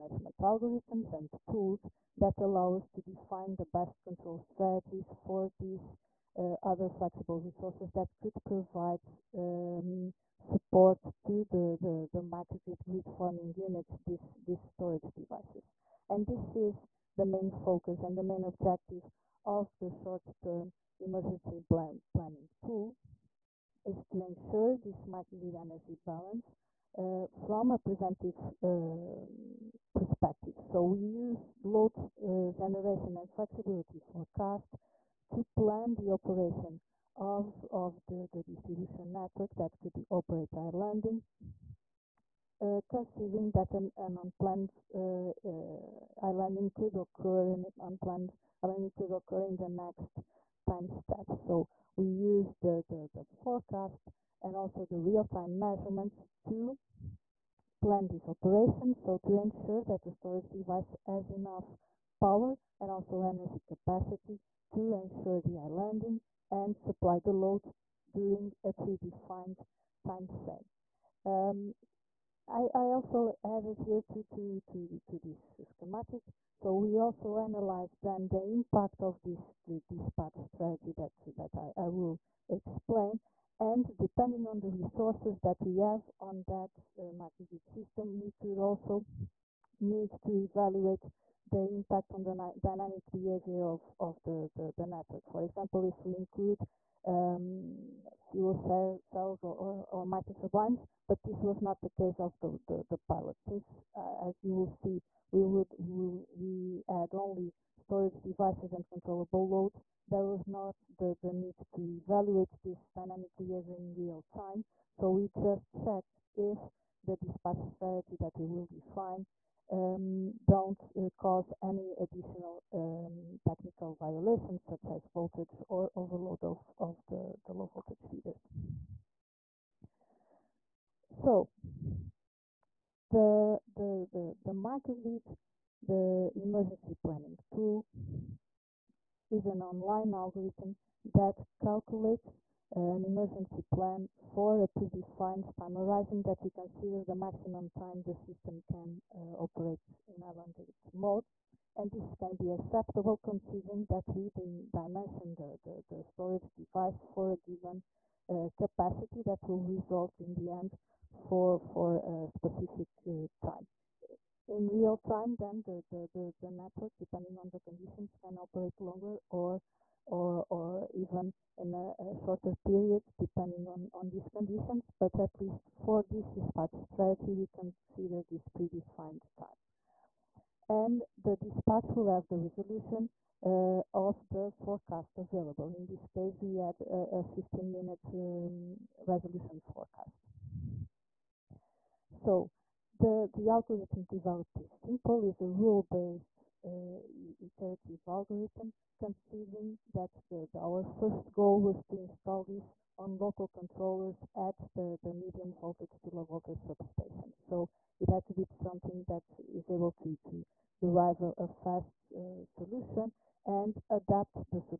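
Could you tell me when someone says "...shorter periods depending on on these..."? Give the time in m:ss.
2:52.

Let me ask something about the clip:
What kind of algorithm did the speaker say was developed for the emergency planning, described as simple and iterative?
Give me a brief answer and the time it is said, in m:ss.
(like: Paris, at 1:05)
Rule-based, at 3:15.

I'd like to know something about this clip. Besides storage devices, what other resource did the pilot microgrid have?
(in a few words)
Controllable loads.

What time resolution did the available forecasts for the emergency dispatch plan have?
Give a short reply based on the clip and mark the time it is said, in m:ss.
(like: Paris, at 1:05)
15 minutes, at 3:07.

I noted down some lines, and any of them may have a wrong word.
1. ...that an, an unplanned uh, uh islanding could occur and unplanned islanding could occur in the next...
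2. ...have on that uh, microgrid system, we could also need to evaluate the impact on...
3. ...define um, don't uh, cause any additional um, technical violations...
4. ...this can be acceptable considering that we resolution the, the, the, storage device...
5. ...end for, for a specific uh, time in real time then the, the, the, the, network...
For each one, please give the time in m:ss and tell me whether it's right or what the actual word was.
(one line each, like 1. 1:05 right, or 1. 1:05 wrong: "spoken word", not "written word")
1. 0:43 right
2. 1:25 right
3. 1:58 right
4. 2:31 wrong: "dimension", not "resolution"
5. 2:40 right.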